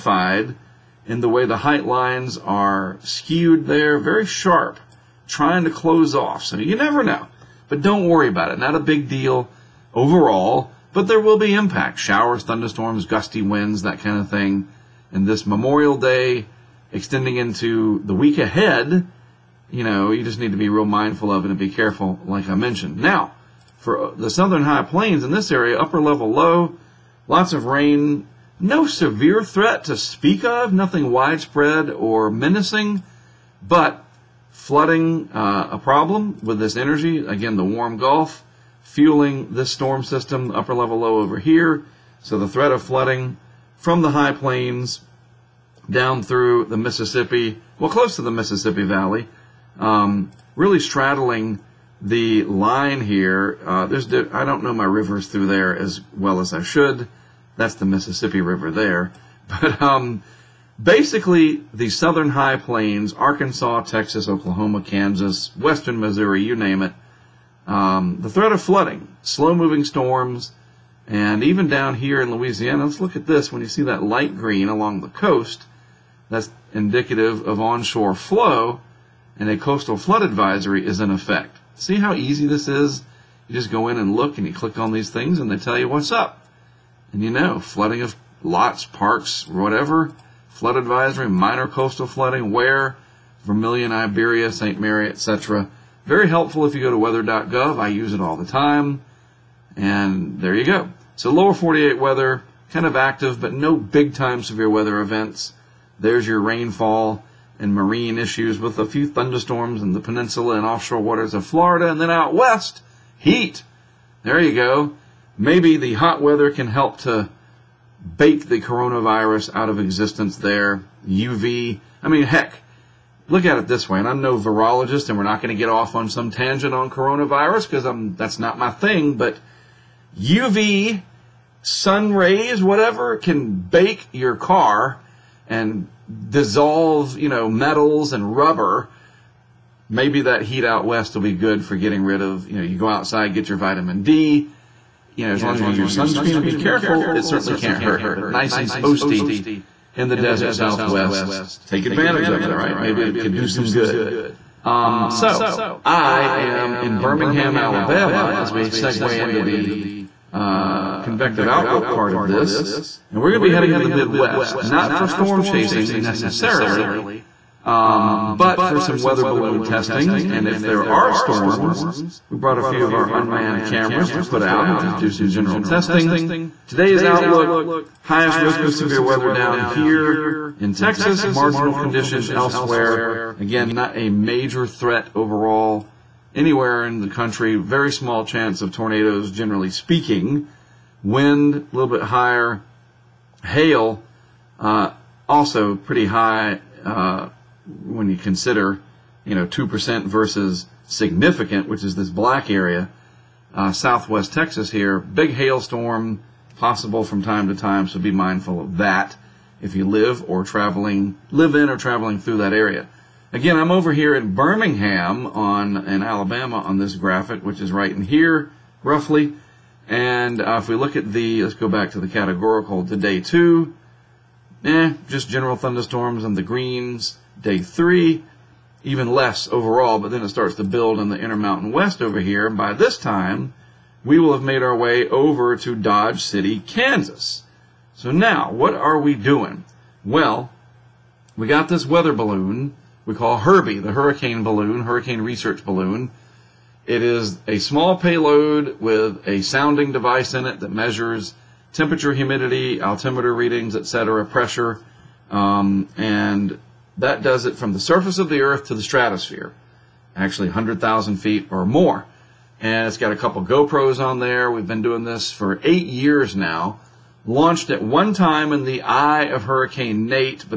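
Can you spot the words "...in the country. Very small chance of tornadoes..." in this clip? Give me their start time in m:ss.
3:06.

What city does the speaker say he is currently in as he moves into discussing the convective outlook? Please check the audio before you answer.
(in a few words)
Birmingham, Alabama.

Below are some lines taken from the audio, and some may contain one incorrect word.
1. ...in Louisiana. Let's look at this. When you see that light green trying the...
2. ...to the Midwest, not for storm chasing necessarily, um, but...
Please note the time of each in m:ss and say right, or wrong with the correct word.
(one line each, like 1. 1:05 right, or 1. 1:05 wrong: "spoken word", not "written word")
1. 1:12 wrong: "along", not "trying"
2. 2:43 right.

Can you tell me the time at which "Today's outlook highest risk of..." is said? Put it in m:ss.
2:56.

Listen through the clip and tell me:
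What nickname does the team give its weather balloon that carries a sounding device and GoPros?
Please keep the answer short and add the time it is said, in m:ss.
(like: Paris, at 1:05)
Herbie, at 4:03.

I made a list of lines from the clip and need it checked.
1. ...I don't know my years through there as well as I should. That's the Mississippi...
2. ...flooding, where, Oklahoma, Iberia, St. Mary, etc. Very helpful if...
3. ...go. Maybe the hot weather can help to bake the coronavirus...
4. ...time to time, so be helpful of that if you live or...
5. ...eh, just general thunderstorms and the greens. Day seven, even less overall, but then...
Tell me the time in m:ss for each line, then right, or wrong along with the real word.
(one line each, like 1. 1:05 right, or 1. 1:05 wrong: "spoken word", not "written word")
1. 0:54 wrong: "rivers", not "years"
2. 1:32 wrong: "Vermilion", not "Oklahoma"
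3. 1:54 right
4. 3:27 wrong: "mindful", not "helpful"
5. 3:44 wrong: "three", not "seven".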